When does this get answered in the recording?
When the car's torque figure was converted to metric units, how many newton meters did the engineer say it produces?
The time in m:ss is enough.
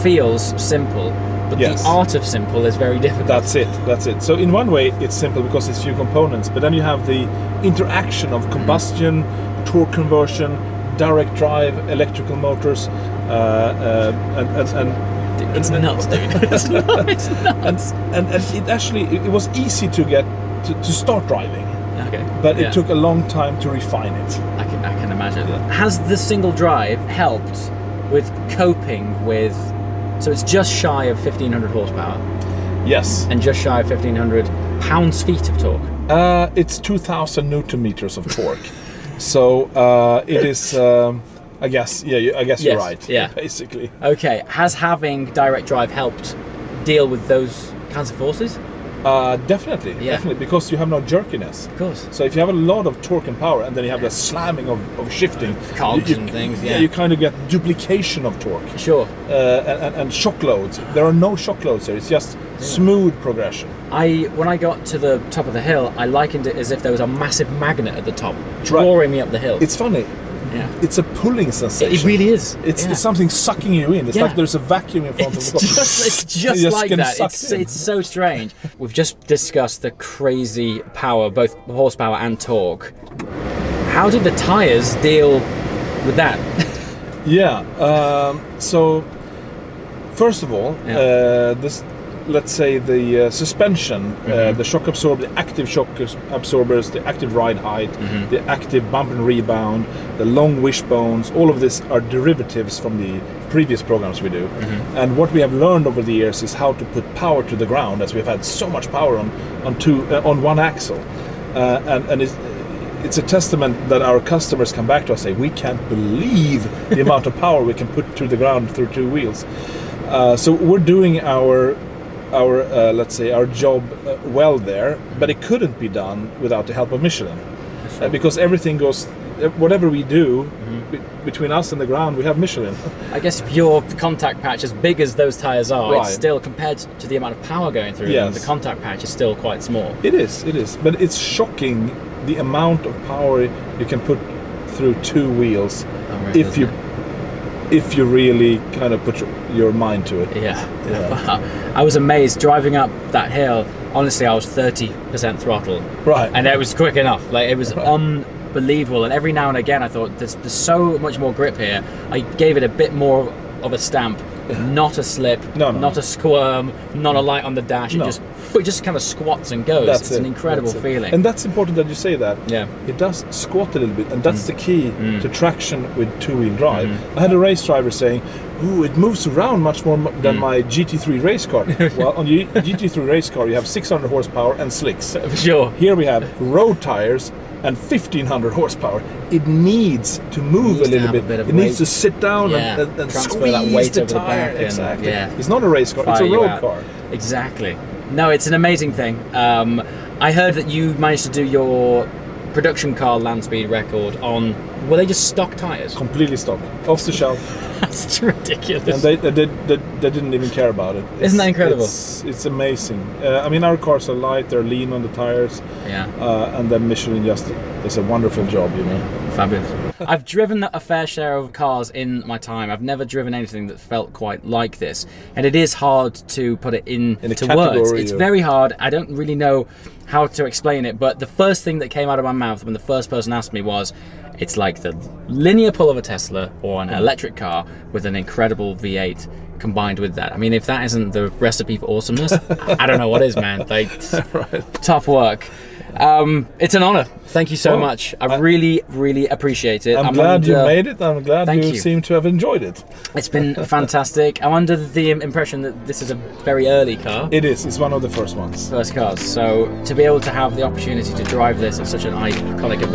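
0:36.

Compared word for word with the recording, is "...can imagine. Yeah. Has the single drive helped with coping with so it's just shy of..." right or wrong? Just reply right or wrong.
right.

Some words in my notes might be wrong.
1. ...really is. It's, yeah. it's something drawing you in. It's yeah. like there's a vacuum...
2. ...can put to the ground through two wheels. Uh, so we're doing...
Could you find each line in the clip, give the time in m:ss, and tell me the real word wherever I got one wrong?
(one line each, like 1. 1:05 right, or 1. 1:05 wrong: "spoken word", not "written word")
1. 1:12 wrong: "sucking", not "drawing"
2. 1:57 right.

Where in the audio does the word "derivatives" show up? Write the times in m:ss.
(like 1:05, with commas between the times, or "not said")
1:42.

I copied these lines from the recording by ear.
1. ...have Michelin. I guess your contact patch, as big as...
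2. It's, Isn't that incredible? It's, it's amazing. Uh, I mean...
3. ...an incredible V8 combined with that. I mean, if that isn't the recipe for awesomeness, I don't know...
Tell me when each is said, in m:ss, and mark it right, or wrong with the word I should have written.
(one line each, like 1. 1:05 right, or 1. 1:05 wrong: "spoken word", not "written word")
1. 2:12 right
2. 3:31 right
3. 3:58 right.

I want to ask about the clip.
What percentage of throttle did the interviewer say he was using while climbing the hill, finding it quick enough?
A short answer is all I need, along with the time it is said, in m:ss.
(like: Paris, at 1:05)
30%, at 2:34.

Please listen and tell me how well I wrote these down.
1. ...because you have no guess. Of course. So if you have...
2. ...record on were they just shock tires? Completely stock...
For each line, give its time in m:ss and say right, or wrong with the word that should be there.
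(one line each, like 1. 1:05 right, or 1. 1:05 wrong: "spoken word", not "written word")
1. 0:50 wrong: "jerkiness", not "guess"
2. 3:23 wrong: "stock", not "shock".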